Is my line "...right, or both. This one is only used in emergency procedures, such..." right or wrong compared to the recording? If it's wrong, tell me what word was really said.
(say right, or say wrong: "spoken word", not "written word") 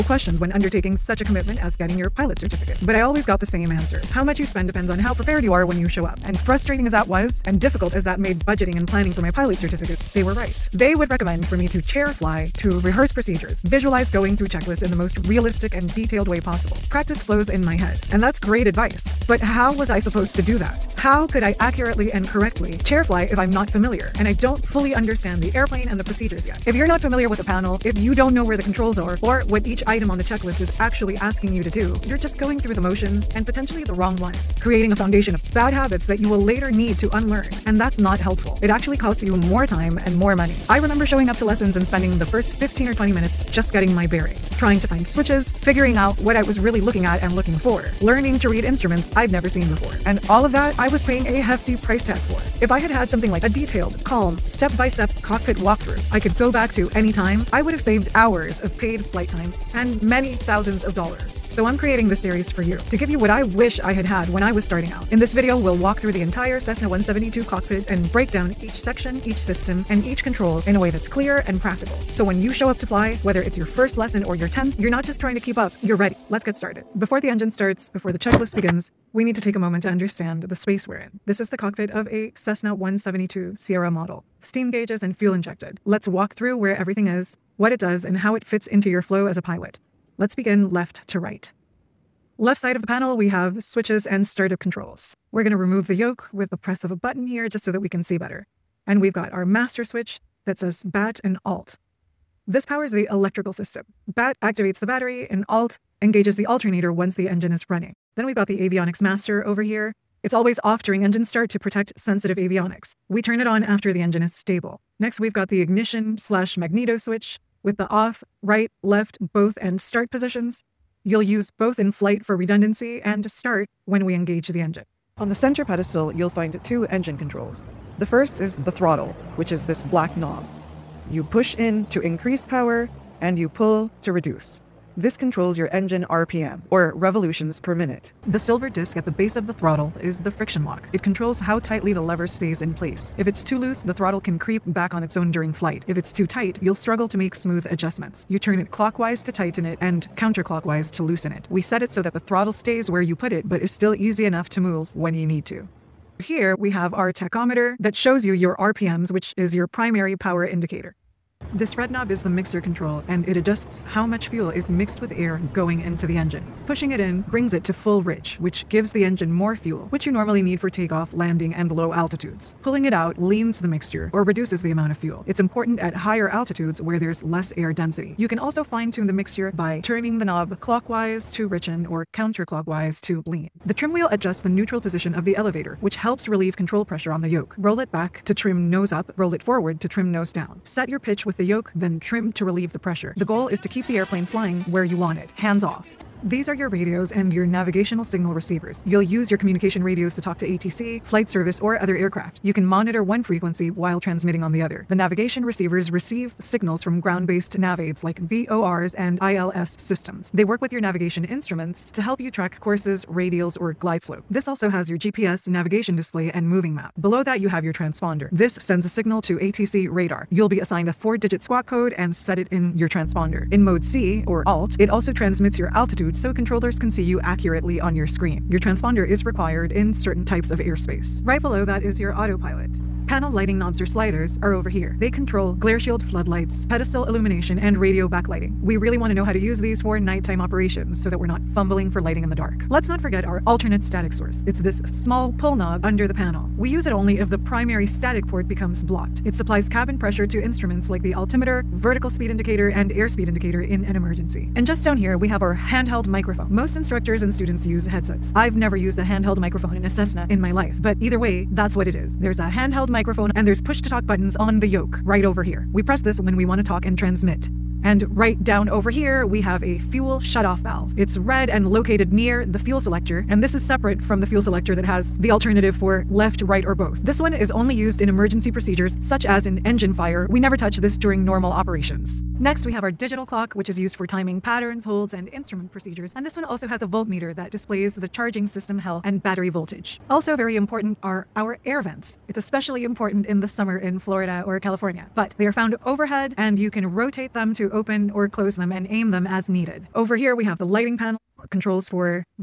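right.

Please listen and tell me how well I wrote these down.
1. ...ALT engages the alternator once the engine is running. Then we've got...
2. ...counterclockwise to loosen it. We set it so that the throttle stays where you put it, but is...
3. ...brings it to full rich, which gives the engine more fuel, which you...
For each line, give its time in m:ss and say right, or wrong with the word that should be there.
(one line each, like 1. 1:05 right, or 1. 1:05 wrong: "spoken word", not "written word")
1. 1:45 right
2. 2:30 right
3. 2:47 right.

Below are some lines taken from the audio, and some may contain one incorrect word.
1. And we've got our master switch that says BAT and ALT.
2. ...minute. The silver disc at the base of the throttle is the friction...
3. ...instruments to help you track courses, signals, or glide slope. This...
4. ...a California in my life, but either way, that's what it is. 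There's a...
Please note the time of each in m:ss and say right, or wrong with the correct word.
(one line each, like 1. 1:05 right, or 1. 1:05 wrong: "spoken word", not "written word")
1. 1:38 right
2. 2:17 right
3. 3:31 wrong: "radials", not "signals"
4. 4:19 wrong: "Cessna", not "California".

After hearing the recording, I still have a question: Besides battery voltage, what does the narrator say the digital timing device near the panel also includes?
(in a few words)
voltmeter.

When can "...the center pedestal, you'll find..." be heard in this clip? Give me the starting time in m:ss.
2:05.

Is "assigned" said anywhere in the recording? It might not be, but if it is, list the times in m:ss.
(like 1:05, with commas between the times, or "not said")
3:40.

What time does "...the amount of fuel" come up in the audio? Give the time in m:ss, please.
2:54.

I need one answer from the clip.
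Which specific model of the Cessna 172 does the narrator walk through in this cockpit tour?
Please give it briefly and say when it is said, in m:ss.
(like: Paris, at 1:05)
Sierra, at 1:23.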